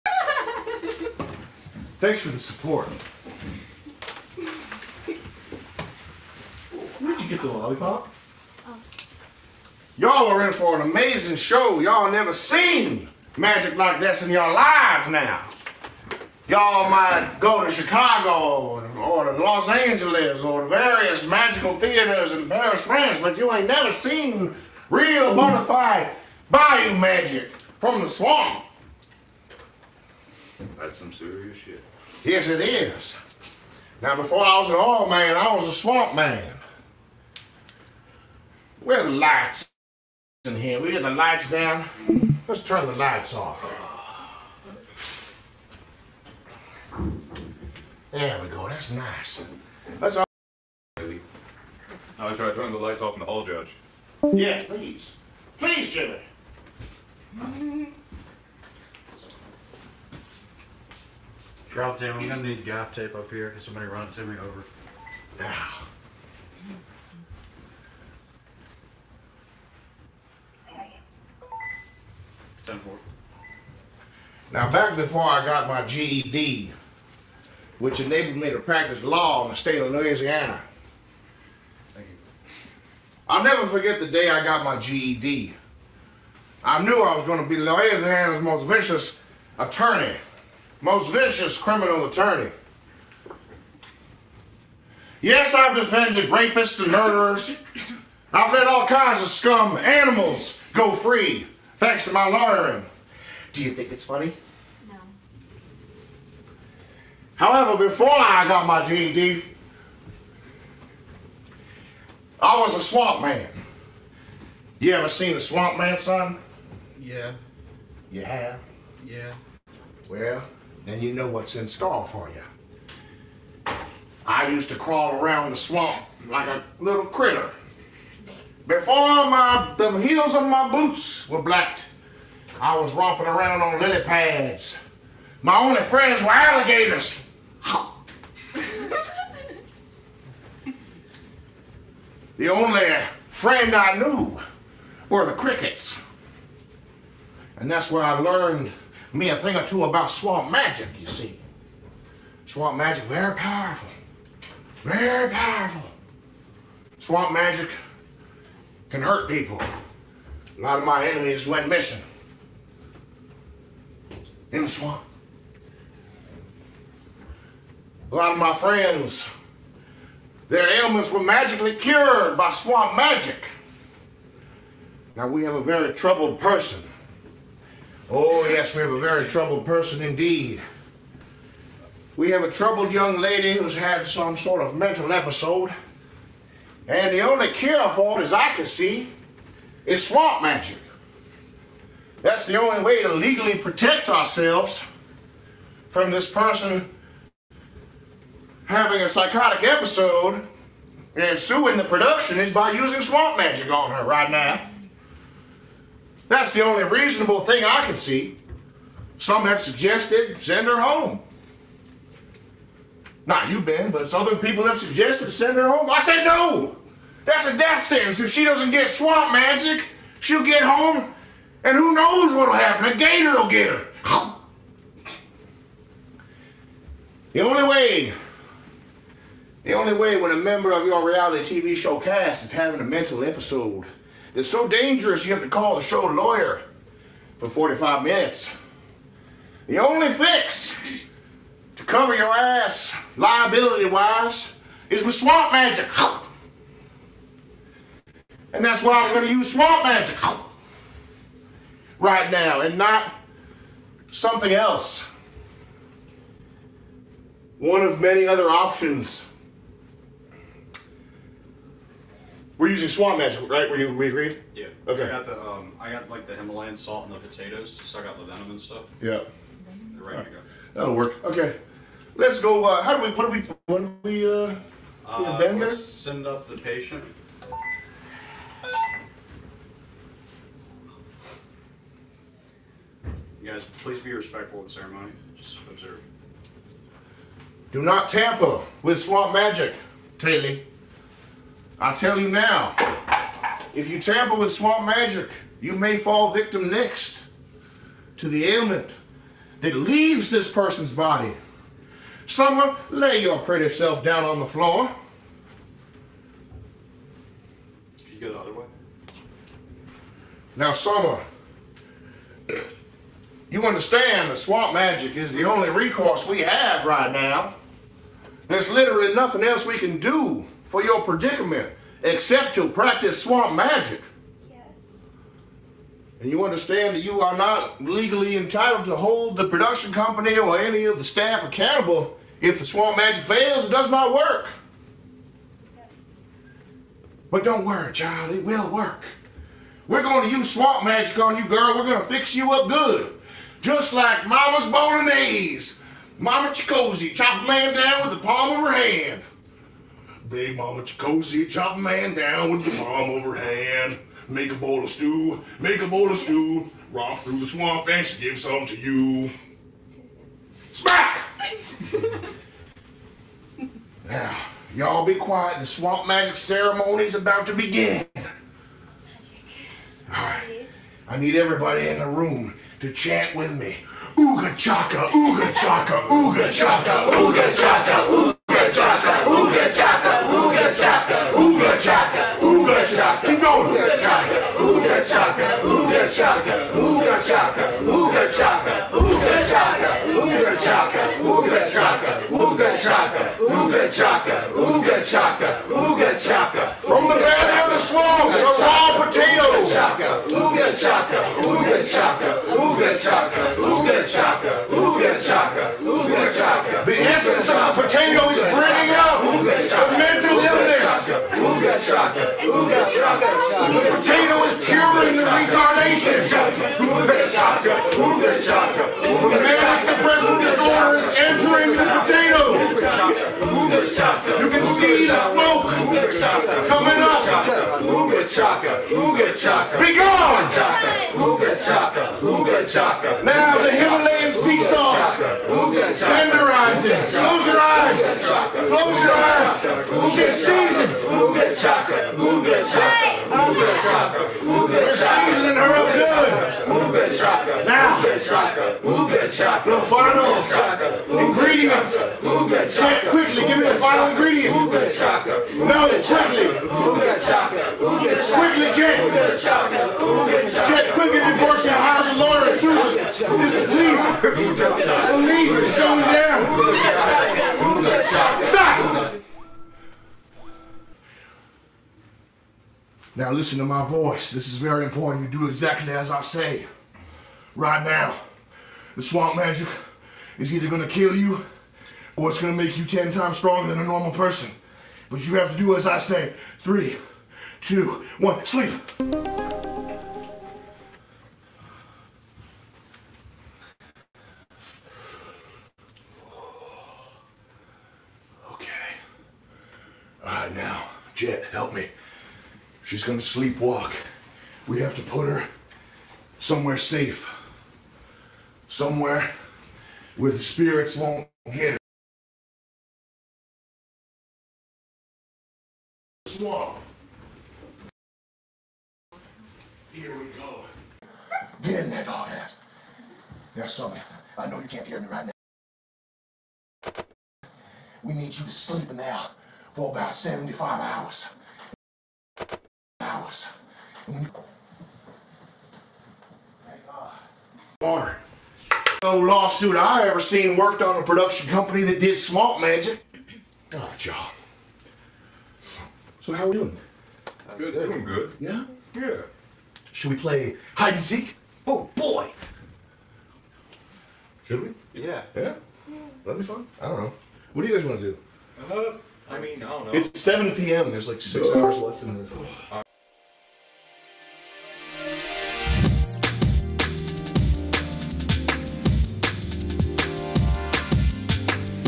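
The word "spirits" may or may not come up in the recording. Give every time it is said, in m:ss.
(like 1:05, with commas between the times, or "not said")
8:30.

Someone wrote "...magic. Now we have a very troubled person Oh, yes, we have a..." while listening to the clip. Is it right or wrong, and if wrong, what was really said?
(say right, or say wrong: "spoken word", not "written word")
right.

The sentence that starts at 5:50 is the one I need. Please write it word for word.
Big Mama Chikosi, chop a man down with the palm overhand.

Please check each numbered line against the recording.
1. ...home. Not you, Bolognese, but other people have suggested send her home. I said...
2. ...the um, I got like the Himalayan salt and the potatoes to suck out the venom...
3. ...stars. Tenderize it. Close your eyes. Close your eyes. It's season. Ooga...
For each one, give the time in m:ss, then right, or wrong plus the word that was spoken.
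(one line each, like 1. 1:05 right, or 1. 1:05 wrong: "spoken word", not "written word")
1. 3:30 wrong: "Ben", not "Bolognese"
2. 4:25 right
3. 7:14 right.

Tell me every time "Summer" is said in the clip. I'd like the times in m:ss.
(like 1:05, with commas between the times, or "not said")
5:02, 5:10.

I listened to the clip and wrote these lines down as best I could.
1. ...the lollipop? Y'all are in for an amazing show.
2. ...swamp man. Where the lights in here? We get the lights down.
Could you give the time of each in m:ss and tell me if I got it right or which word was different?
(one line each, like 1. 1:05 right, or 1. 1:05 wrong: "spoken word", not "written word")
1. 0:07 right
2. 0:35 right.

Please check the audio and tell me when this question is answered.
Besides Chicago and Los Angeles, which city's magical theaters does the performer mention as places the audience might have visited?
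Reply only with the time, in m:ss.
0:22.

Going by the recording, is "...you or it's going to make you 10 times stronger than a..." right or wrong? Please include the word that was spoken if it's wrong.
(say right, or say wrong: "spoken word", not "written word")
right.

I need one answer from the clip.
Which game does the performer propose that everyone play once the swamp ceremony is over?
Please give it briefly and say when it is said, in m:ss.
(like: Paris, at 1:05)
hide and seek, at 9:10.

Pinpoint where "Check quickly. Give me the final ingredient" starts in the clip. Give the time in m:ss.
7:32.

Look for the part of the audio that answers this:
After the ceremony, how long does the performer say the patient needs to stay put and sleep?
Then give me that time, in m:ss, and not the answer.
8:50.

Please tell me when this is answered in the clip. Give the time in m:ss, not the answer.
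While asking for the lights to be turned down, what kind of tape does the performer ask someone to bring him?
1:02.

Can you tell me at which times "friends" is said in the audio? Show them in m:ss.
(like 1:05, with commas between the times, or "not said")
2:15, 2:23, 2:48.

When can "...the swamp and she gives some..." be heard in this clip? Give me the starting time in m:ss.
5:57.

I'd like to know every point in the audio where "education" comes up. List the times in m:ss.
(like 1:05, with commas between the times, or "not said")
not said.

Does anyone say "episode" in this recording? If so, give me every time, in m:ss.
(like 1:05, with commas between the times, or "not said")
3:05, 3:19, 3:53.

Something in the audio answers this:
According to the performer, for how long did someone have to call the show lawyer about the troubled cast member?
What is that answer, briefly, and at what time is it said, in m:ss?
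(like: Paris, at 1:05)
45 minutes, at 3:57.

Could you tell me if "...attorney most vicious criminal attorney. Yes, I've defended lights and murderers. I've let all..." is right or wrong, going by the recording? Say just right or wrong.
wrong.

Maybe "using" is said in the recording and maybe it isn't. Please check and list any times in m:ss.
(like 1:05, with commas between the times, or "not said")
3:22, 4:22.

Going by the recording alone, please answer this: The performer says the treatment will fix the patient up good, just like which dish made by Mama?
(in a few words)
Bolognese.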